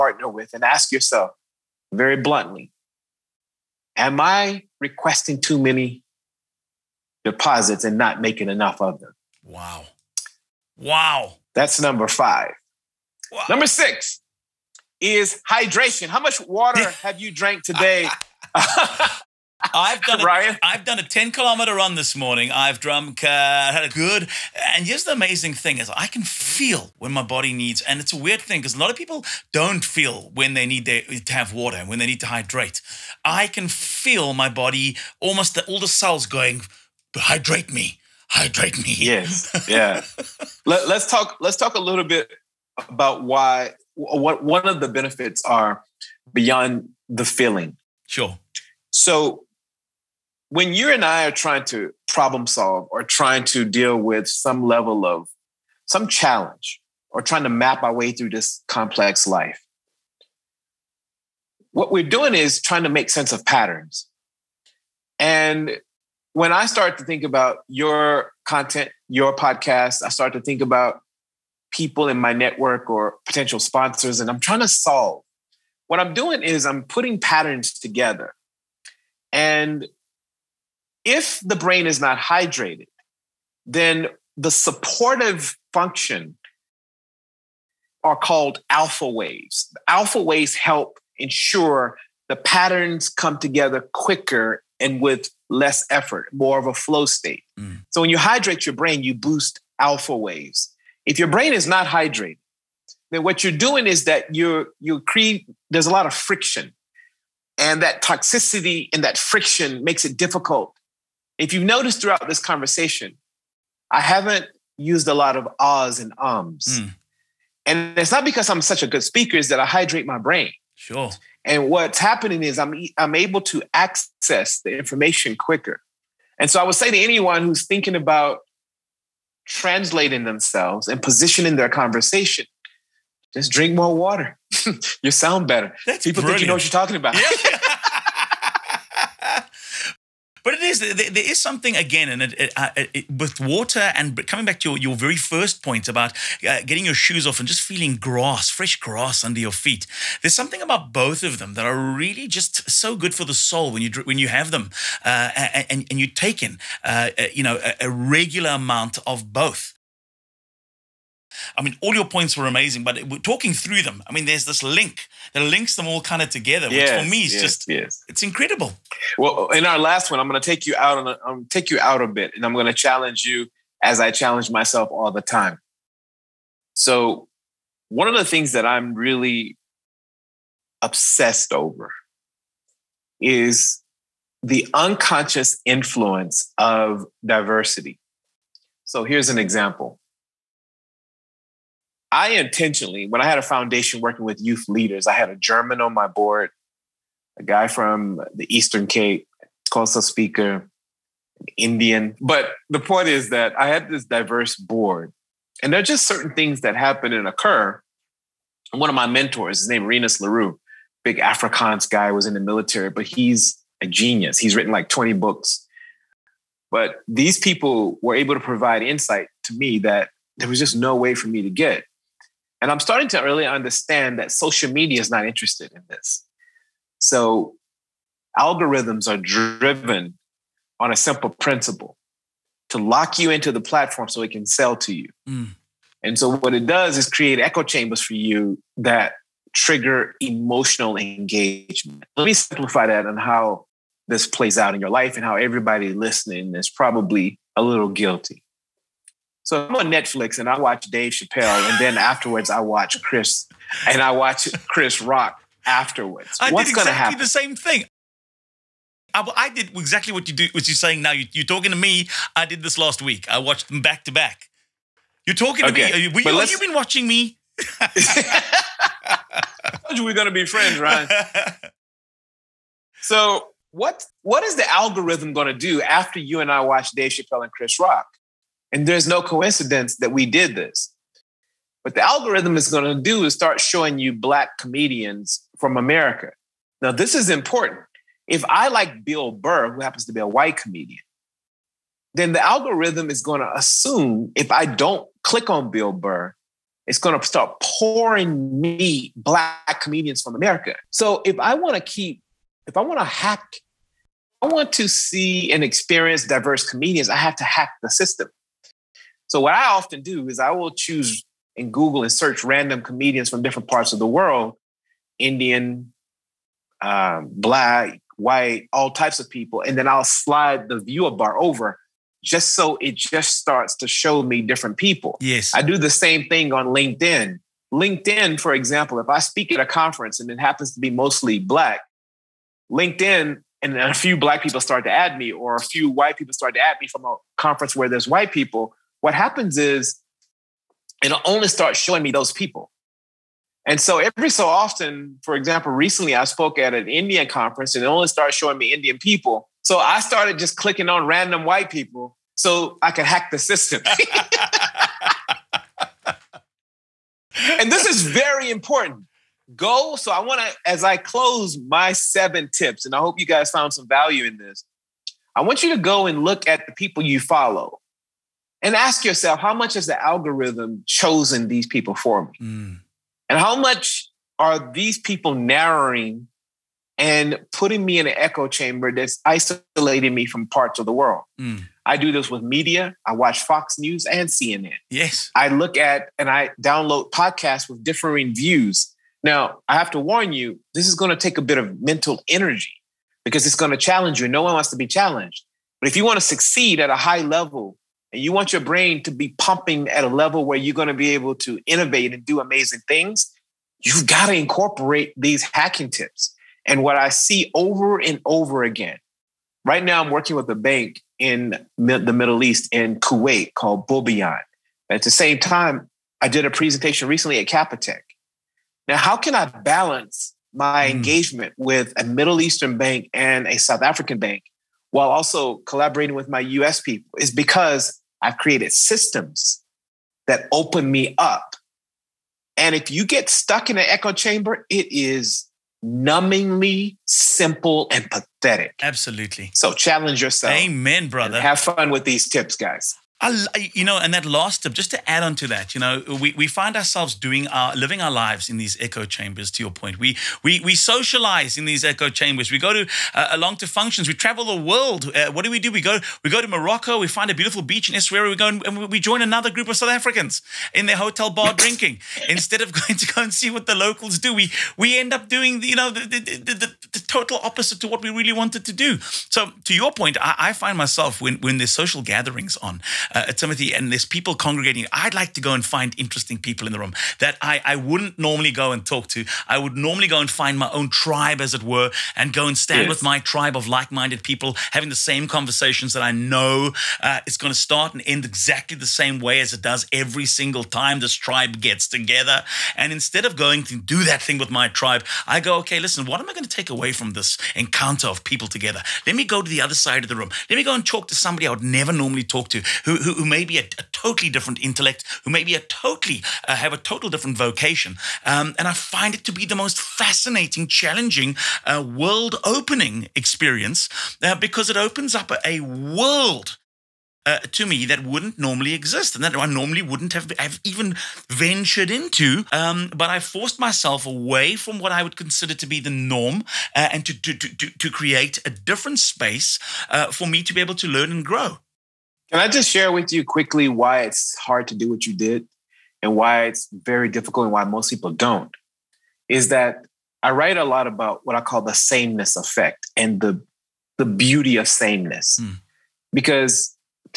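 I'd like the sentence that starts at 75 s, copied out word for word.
What I'm doing is I'm putting patterns together.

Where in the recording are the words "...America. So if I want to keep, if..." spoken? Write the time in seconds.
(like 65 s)
300 s.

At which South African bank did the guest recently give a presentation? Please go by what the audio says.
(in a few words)
Capitec.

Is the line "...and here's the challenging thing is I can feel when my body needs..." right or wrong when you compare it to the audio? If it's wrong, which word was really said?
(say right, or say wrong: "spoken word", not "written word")
wrong: "amazing", not "challenging".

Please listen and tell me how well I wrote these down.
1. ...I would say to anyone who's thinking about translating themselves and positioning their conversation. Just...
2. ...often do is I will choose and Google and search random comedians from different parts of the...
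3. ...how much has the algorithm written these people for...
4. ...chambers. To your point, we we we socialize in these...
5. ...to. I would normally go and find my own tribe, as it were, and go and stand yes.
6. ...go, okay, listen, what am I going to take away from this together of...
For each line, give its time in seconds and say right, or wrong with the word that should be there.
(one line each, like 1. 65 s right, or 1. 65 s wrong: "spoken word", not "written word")
1. 126 s right
2. 309 s right
3. 369 s wrong: "chosen", not "written"
4. 449 s right
5. 479 s right
6. 495 s wrong: "encounter", not "together".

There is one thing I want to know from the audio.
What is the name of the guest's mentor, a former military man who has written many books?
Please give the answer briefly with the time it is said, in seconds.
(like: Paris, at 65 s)
Renus LaRue, at 209 s.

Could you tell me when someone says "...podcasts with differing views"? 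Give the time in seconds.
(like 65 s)
387 s.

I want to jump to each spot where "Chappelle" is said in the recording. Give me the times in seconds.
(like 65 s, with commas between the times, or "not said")
251 s, 277 s.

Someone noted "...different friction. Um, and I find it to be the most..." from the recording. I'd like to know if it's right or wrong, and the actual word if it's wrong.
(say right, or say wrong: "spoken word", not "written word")
wrong: "vocation", not "friction".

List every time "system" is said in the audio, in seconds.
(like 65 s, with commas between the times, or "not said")
307 s, 353 s, 428 s.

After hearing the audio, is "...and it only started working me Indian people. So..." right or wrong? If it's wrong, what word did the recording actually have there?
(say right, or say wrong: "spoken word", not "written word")
wrong: "showing", not "working".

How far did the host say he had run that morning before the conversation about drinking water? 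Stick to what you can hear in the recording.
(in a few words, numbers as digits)
10 kilometers.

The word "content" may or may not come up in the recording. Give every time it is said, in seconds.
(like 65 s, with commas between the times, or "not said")
68 s.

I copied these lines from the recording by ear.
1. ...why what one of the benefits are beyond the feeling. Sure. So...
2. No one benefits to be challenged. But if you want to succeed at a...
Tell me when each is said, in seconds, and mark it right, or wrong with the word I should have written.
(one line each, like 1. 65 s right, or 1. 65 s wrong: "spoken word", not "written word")
1. 43 s right
2. 394 s wrong: "wants", not "benefits".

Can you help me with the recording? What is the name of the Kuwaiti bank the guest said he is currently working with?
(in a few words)
Boubyan.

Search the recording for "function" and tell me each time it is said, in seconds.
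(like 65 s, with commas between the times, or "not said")
85 s, 453 s.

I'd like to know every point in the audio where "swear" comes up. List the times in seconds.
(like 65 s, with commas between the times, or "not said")
not said.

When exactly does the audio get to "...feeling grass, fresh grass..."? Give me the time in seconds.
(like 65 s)
147 s.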